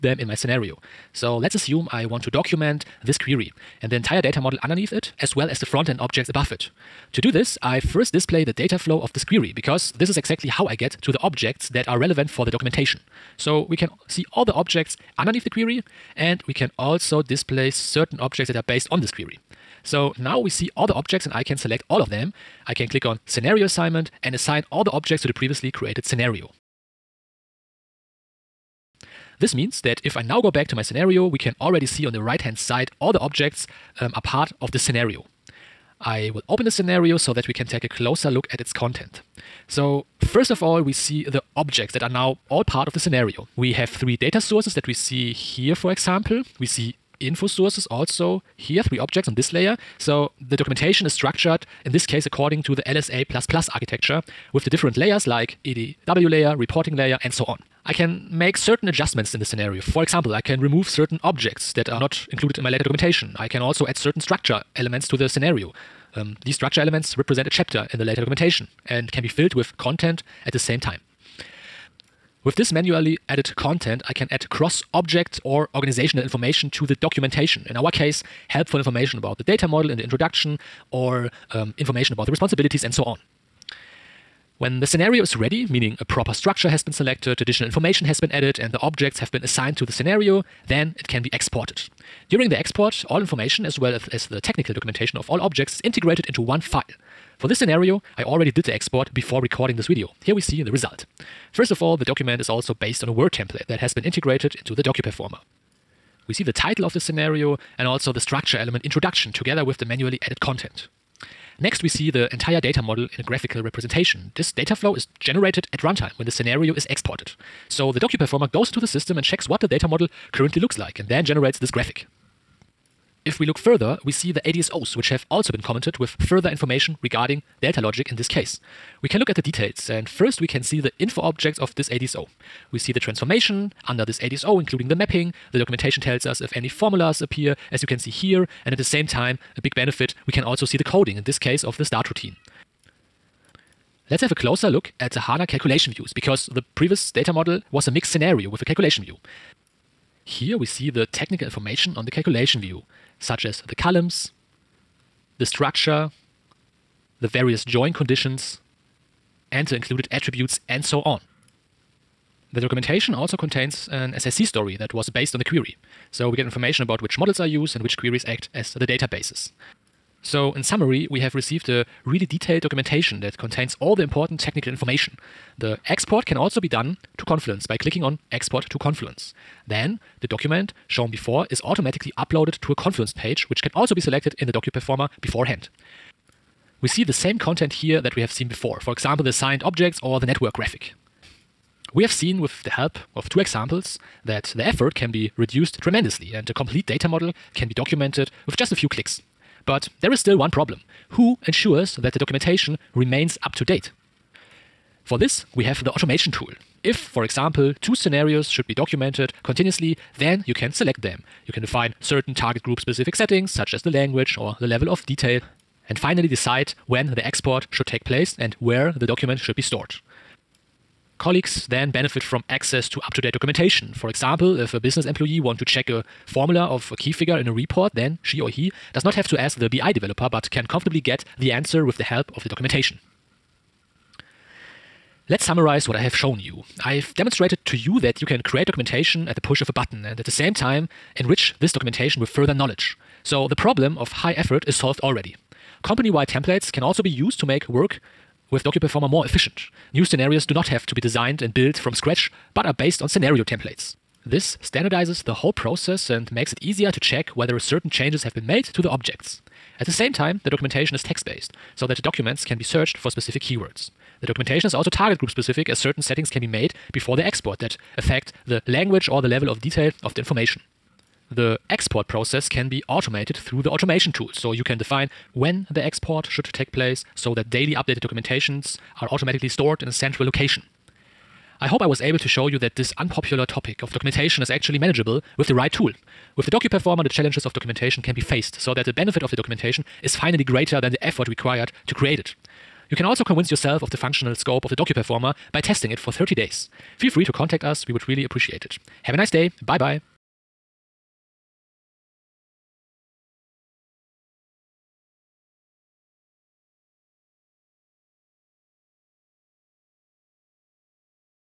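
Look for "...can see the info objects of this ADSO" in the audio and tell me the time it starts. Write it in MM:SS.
02:10.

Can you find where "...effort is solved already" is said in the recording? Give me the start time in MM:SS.
04:04.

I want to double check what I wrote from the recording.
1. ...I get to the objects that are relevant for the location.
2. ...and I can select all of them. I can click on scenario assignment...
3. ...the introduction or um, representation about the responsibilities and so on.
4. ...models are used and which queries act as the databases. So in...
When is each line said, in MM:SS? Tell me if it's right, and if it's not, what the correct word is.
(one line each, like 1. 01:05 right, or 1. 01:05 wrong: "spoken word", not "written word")
1. 00:10 wrong: "documentation", not "location"
2. 00:21 right
3. 01:19 wrong: "information", not "representation"
4. 02:47 right.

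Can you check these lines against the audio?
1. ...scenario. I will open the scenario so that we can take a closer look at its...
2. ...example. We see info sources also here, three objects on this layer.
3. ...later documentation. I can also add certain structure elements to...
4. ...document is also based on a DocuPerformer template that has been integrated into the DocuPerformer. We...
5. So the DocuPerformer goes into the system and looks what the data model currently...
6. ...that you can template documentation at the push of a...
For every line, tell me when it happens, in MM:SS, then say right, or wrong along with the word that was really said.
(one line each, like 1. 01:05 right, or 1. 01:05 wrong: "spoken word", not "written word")
1. 00:34 right
2. 00:45 right
3. 01:02 right
4. 01:42 wrong: "Word", not "DocuPerformer"
5. 01:57 wrong: "checks", not "looks"
6. 03:57 wrong: "create", not "template".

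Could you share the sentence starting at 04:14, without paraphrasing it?
This standardizes the whole process and makes it easier to check whether certain changes have been made to the objects.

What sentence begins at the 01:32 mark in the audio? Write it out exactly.
During the export, all information as well as, as the technical documentation of all objects is integrated into one file.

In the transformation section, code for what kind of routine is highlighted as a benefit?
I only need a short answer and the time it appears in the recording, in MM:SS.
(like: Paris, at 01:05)
Start routine, at 02:21.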